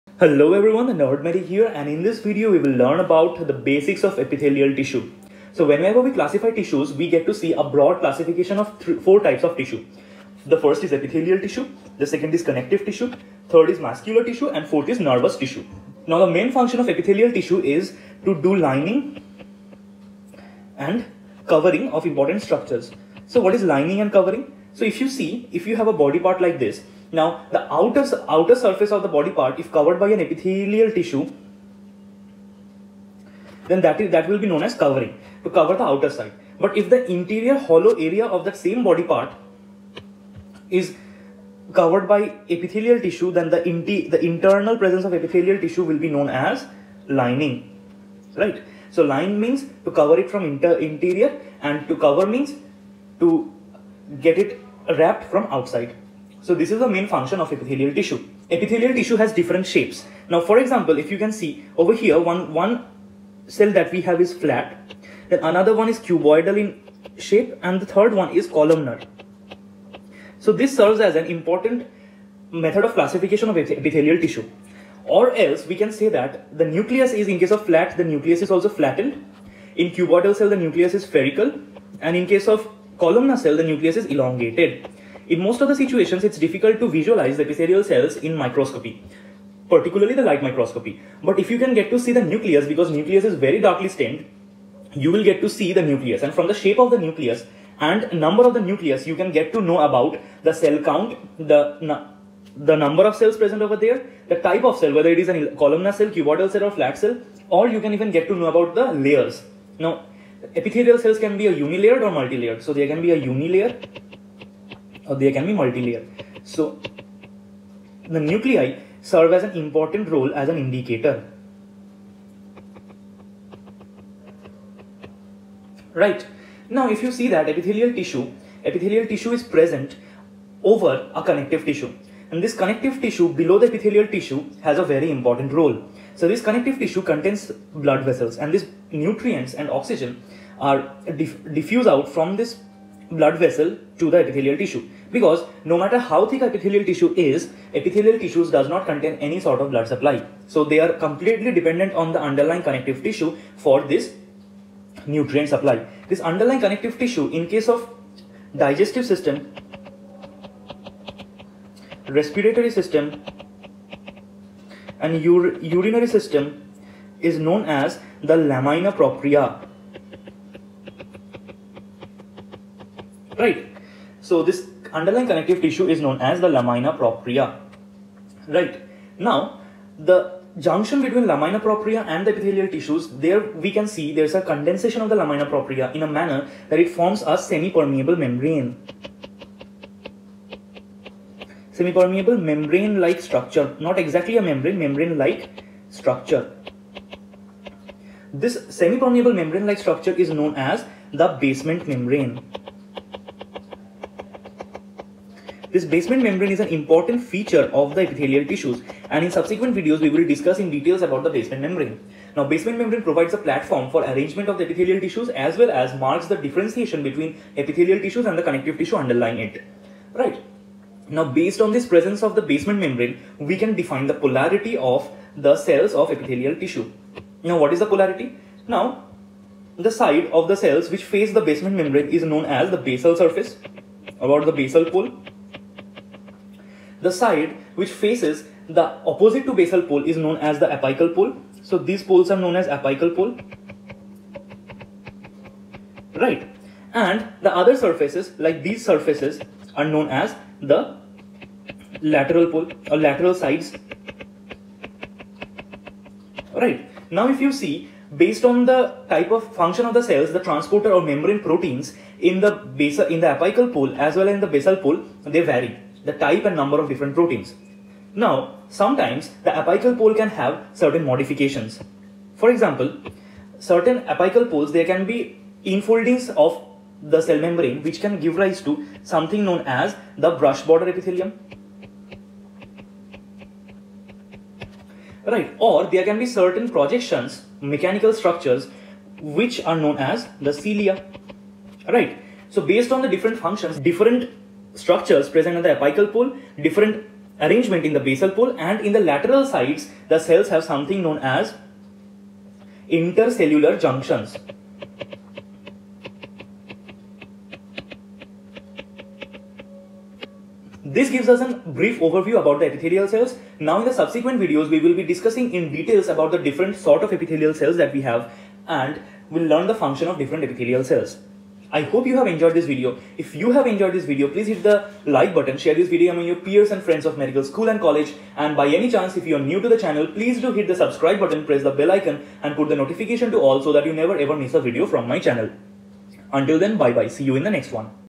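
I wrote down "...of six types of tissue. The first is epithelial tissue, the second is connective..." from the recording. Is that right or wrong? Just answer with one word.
wrong.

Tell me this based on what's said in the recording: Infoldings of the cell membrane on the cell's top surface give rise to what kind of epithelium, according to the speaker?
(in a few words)
Brush border epithelium.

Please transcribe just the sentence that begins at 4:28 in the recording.
Now, sometimes the apical pole can have certain modifications.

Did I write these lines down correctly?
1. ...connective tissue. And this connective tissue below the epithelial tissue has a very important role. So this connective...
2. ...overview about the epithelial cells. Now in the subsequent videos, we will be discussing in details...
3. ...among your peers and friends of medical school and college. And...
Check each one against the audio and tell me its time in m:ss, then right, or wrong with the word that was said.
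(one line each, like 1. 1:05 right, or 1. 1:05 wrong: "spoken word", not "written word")
1. 2:11 right
2. 5:12 right
3. 5:26 right.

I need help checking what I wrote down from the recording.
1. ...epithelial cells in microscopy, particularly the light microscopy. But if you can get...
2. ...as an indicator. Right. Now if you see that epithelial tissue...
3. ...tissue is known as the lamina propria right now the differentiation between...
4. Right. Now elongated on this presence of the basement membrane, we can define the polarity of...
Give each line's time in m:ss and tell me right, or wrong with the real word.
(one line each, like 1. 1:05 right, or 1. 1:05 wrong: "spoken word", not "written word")
1. 1:27 right
2. 2:00 right
3. 2:55 wrong: "junction", not "differentiation"
4. 3:40 wrong: "based", not "elongated".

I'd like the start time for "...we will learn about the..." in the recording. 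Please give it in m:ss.
0:02.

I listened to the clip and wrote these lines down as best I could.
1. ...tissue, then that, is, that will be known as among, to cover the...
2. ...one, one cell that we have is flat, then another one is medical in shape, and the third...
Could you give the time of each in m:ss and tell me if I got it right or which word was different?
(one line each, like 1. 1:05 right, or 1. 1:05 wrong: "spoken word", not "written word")
1. 0:30 wrong: "covering", not "among"
2. 1:02 wrong: "cuboidal", not "medical".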